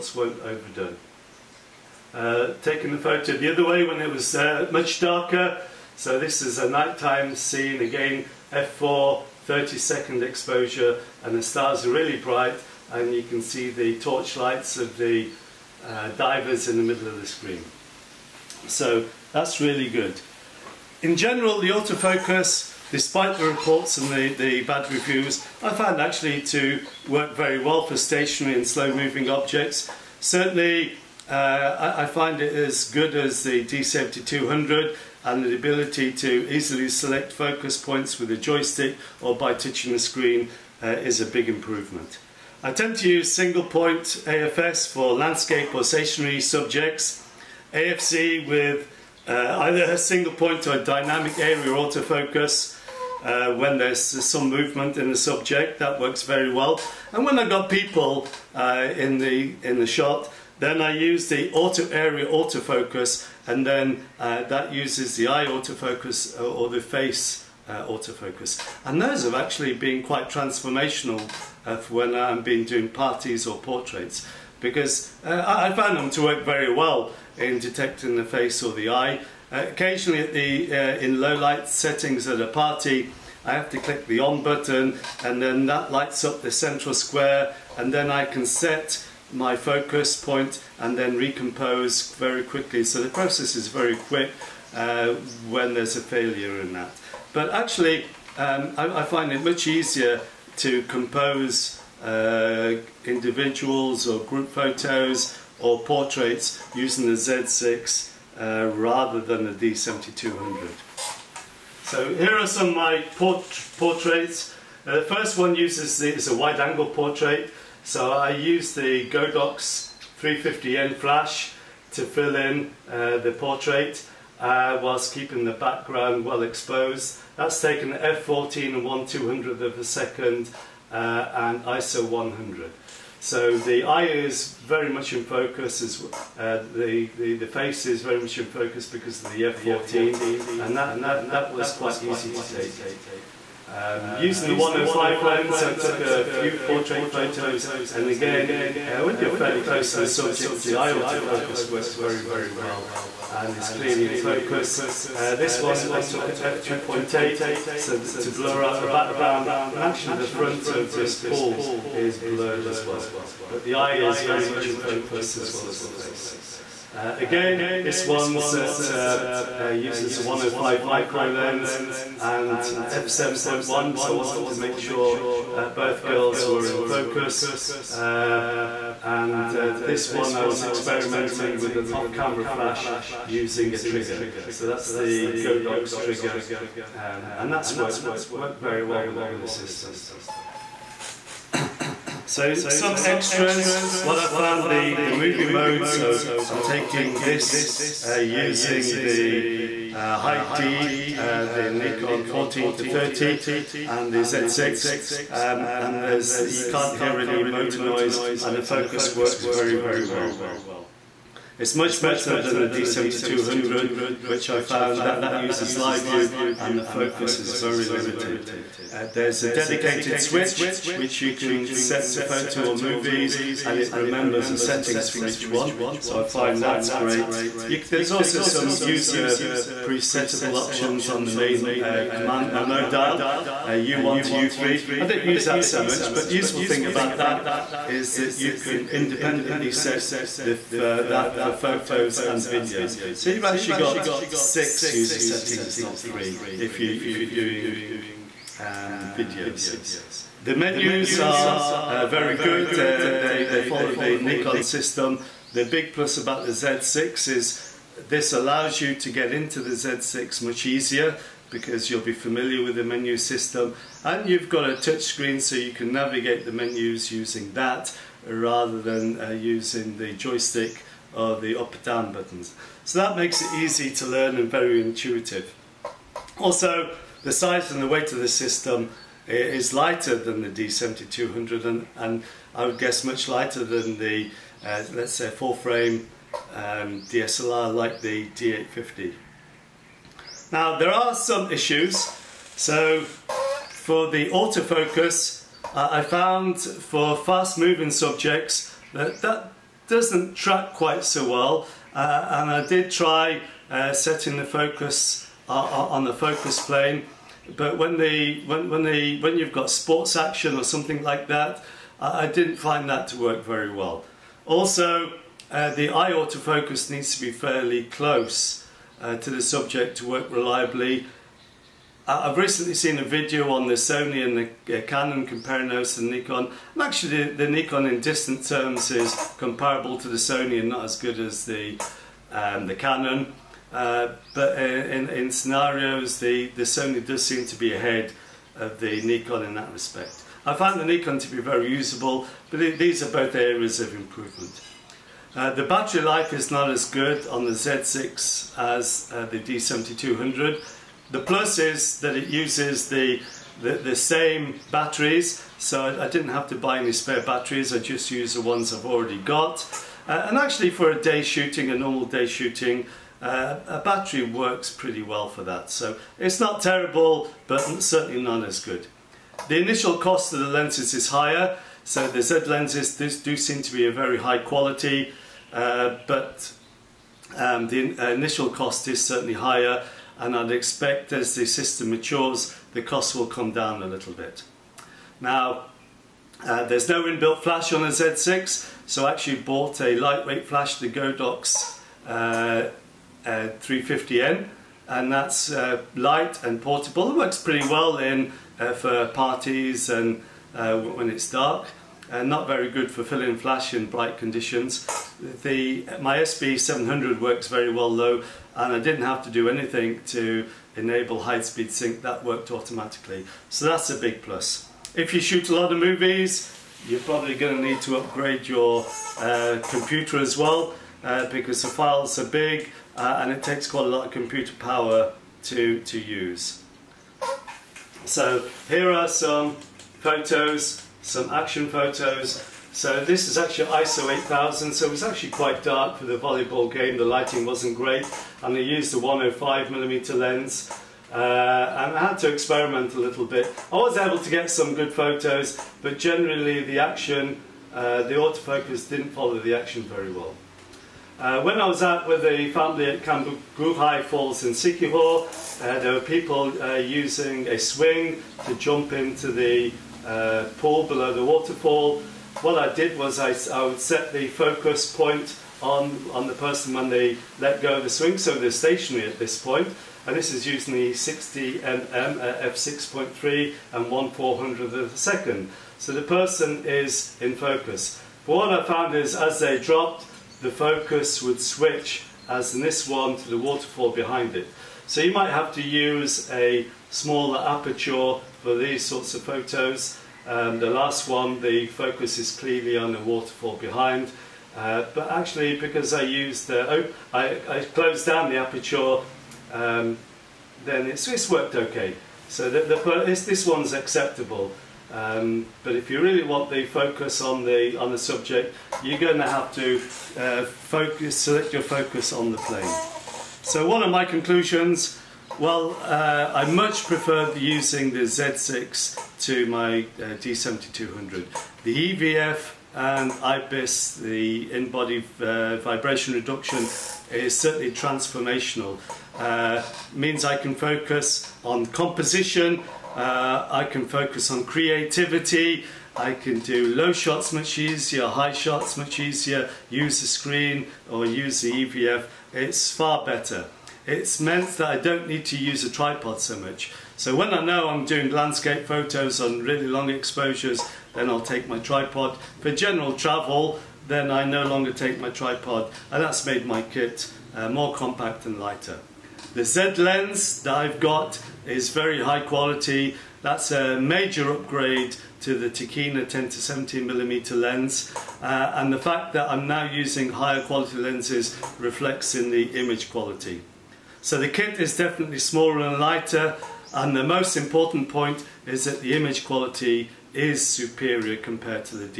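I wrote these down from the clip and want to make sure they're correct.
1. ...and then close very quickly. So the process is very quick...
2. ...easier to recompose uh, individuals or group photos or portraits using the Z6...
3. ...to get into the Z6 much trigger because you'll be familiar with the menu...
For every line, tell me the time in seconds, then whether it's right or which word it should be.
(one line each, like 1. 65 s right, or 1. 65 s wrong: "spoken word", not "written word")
1. 90 s wrong: "recompose", not "close"
2. 99 s wrong: "compose", not "recompose"
3. 258 s wrong: "easier", not "trigger".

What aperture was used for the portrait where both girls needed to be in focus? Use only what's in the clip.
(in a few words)
f7.1.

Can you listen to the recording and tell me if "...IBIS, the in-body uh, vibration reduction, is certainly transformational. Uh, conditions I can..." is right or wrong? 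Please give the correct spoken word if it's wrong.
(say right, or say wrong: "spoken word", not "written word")
wrong: "means", not "conditions".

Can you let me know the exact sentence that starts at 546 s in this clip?
So when I know I'm doing landscape photos on really long exposures, then I'll take my tripod.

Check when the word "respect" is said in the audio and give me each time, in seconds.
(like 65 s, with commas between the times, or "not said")
339 s.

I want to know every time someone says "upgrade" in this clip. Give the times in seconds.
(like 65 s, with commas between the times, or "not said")
417 s, 564 s.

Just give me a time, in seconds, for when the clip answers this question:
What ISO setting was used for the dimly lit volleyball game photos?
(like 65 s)
433 s.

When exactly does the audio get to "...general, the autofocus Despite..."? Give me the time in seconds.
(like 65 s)
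21 s.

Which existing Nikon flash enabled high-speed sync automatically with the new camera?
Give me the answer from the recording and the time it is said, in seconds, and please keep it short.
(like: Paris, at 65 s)
SB700, at 406 s.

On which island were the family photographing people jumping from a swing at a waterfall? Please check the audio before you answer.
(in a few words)
Siquijor.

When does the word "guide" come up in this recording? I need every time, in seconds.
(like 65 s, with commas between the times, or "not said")
not said.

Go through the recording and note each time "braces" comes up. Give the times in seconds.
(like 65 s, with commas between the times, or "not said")
not said.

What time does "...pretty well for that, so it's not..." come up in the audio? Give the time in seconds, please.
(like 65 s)
364 s.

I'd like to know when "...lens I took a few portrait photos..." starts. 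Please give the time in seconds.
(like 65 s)
145 s.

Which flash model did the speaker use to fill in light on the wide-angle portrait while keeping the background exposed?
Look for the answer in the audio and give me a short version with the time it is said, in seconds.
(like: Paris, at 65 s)
Godox 350N, at 119 s.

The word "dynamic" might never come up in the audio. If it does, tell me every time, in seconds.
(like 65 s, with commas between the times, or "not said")
50 s.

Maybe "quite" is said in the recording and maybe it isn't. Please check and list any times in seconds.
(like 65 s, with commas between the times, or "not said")
70 s, 141 s, 300 s, 423 s, 435 s.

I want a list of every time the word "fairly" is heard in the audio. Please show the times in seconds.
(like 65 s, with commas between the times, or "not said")
149 s, 317 s.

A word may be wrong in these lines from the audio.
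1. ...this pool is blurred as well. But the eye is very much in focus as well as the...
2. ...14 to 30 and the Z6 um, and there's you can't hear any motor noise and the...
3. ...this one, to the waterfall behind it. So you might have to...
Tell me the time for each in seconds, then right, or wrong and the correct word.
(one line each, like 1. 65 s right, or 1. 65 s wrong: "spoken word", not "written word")
1. 160 s right
2. 202 s right
3. 482 s right.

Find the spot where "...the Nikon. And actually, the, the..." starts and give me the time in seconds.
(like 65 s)
325 s.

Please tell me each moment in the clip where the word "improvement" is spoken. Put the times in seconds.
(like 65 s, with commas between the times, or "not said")
41 s, 343 s.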